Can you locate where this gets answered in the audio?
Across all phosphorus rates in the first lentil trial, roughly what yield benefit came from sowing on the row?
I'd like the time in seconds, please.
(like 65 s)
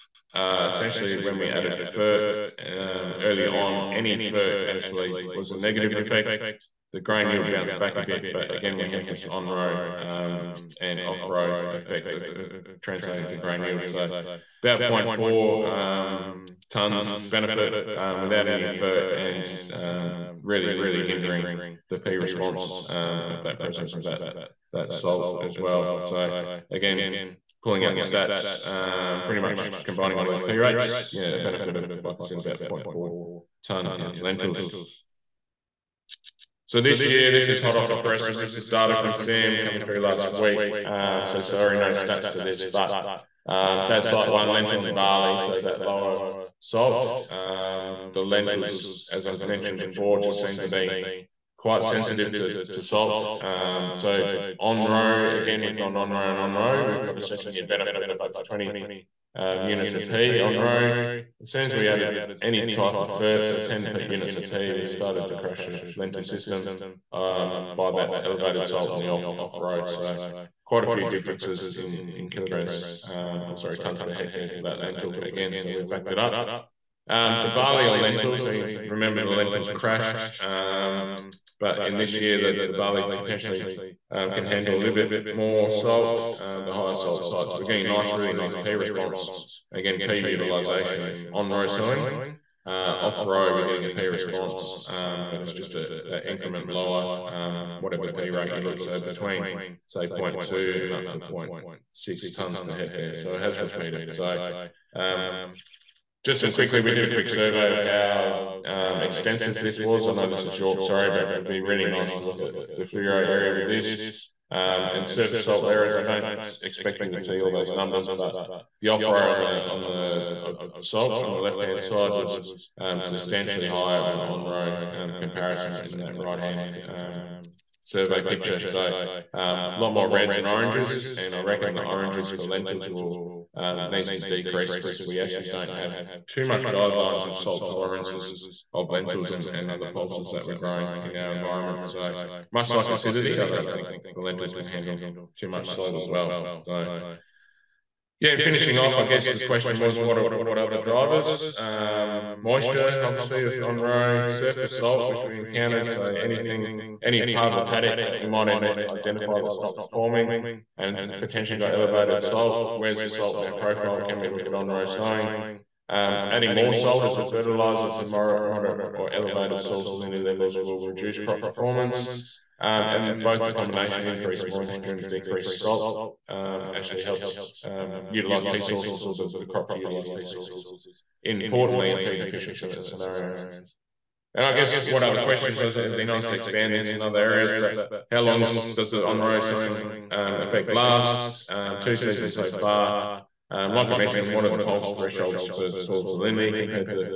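32 s.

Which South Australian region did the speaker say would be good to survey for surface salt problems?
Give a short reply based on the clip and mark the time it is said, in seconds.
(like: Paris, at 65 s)
Fleurieu, at 112 s.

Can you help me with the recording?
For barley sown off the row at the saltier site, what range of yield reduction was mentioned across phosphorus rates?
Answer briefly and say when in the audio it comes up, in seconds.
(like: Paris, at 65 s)
0.2 to 0.6 t/ha, at 100 s.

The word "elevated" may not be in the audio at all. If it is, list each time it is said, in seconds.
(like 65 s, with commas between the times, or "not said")
68 s, 161 s, 169 s.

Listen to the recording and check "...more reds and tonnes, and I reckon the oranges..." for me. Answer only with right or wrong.
wrong.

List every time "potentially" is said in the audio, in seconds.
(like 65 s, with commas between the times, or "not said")
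83 s, 161 s.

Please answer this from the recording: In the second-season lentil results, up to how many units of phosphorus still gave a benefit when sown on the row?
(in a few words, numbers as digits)
20 units.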